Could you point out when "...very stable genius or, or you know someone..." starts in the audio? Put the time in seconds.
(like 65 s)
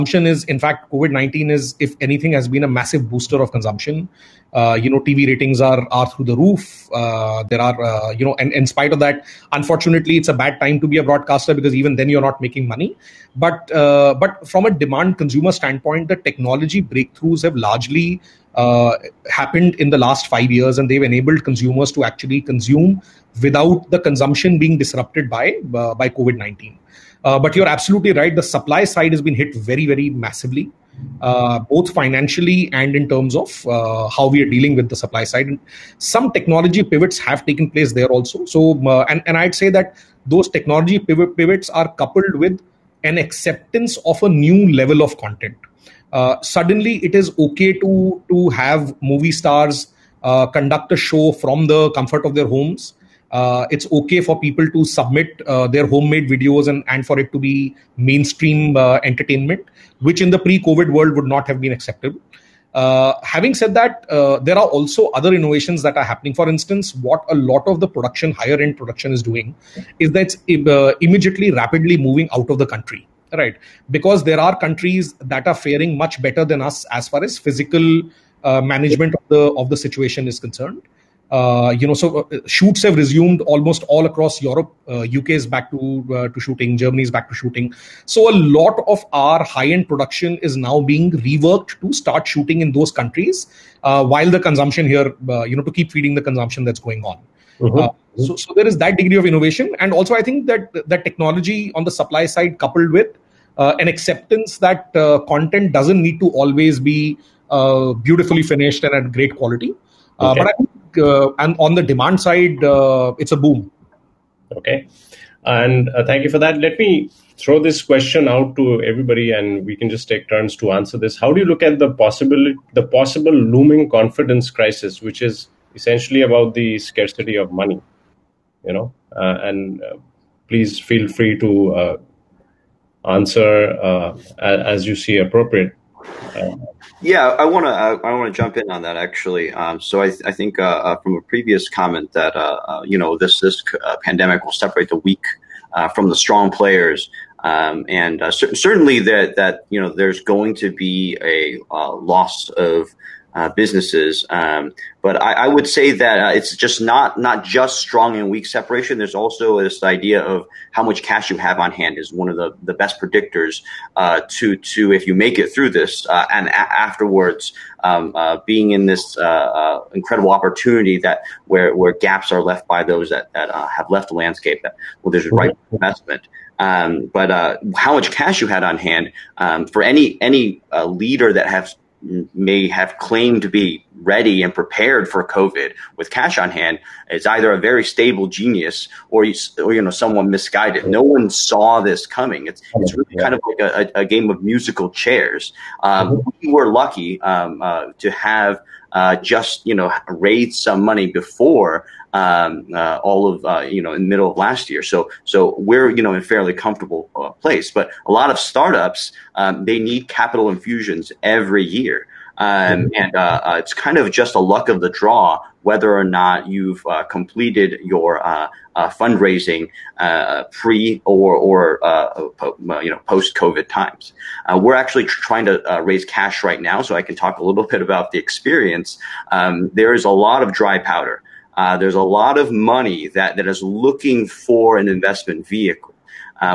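187 s.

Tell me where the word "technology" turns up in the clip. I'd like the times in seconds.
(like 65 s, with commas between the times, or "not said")
16 s, 36 s, 40 s, 101 s.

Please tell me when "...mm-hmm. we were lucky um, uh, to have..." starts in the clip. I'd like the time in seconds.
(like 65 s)
196 s.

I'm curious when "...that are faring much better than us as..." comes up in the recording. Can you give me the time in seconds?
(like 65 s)
75 s.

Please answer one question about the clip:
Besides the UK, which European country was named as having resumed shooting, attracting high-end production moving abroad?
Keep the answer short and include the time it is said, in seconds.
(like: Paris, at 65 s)
Germany, at 86 s.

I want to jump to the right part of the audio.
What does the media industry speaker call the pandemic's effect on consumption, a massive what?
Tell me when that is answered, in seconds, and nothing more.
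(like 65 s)
3 s.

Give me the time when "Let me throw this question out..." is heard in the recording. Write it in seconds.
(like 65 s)
116 s.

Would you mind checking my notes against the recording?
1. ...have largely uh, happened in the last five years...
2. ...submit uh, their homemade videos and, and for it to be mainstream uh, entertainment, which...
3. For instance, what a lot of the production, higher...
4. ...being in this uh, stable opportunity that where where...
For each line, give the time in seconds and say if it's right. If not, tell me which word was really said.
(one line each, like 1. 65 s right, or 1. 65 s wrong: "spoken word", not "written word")
1. 17 s right
2. 54 s right
3. 66 s right
4. 168 s wrong: "incredible", not "stable".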